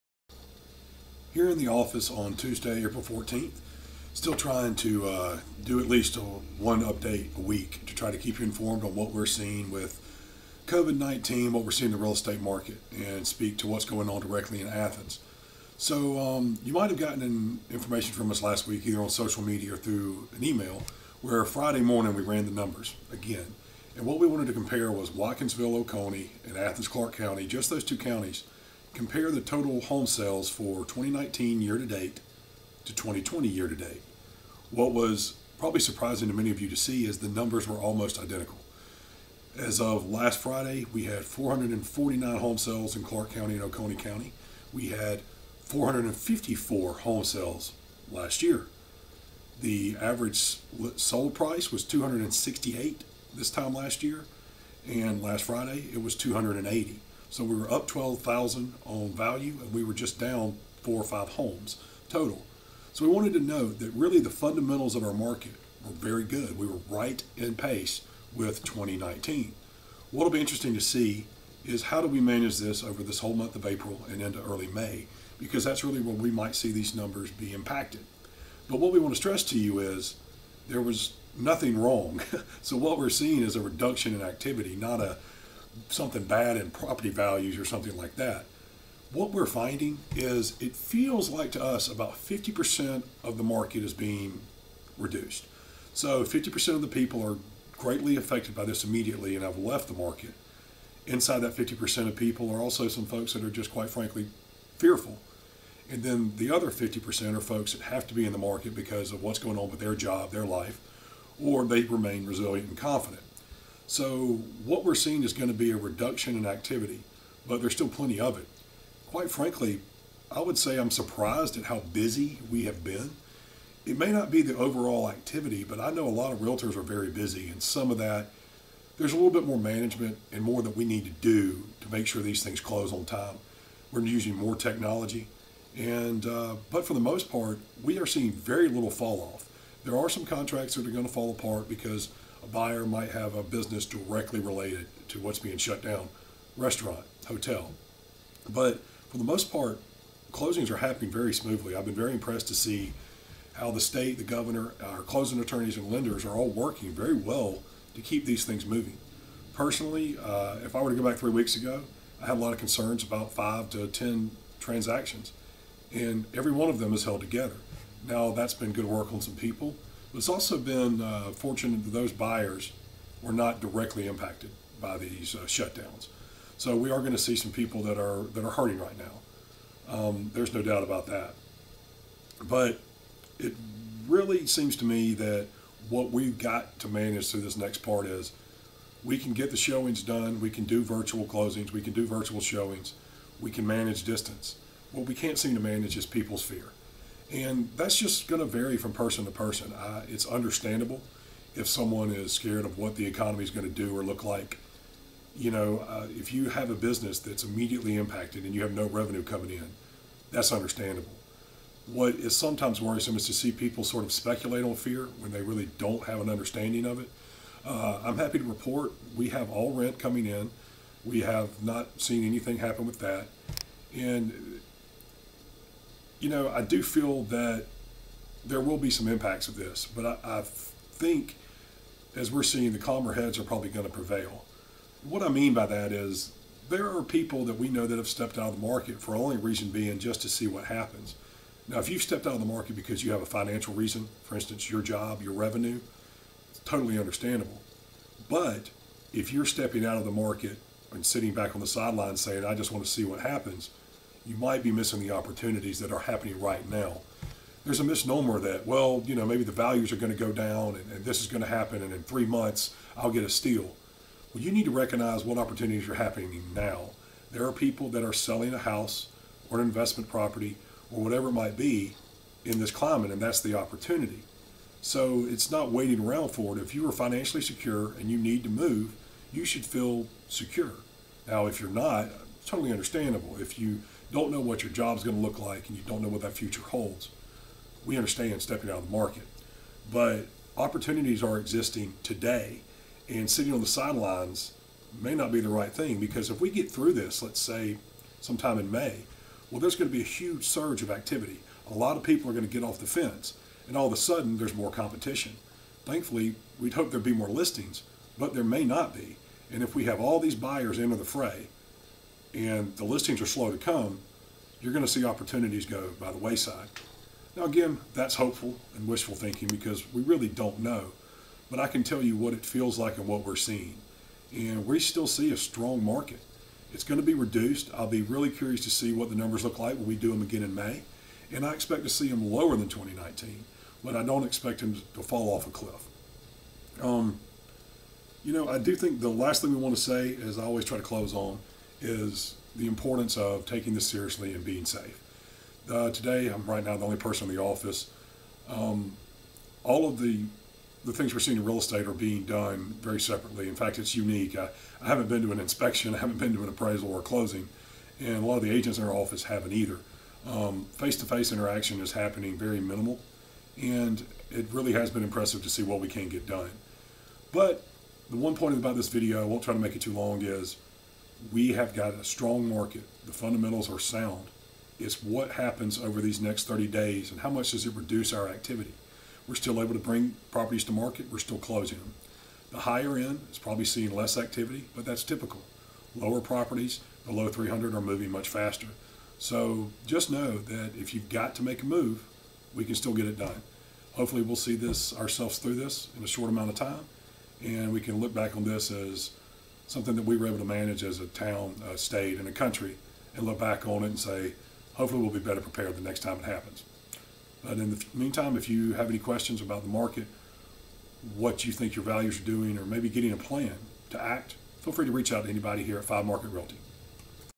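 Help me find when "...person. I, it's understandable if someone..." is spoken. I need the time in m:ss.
3:19.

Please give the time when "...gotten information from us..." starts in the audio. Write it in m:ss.
0:16.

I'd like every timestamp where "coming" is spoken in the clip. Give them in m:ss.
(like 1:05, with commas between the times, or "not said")
3:29, 3:39.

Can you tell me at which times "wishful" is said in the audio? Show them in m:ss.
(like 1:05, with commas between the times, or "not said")
5:18.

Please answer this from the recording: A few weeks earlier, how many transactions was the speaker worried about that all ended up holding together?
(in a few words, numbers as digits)
5 to 10.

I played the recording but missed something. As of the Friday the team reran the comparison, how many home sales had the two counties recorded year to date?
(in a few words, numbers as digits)
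449.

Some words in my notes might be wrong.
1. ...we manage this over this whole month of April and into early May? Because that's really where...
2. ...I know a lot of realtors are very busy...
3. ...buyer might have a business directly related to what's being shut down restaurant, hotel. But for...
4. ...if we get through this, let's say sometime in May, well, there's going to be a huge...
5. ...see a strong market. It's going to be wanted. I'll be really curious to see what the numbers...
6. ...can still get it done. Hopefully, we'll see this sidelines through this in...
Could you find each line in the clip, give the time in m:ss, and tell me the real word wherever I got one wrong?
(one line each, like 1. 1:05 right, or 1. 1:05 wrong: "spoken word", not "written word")
1. 1:12 right
2. 2:05 right
3. 2:22 right
4. 4:56 right
5. 5:25 wrong: "reduced", not "wanted"
6. 6:32 wrong: "ourselves", not "sidelines".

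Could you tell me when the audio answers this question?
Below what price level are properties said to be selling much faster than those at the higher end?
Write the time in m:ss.
6:27.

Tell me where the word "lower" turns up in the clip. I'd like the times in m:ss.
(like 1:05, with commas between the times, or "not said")
5:32, 6:25.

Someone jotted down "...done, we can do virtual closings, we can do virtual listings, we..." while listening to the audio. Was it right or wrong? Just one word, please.
wrong.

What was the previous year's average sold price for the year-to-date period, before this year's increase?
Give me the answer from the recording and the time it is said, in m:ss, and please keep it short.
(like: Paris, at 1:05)
268, at 0:51.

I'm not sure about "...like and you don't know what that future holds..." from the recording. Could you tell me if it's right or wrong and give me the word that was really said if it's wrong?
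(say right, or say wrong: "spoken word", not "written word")
right.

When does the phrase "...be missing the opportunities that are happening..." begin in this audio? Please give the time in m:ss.
4:14.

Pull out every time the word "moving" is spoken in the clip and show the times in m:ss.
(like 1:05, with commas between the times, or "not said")
2:38, 6:27.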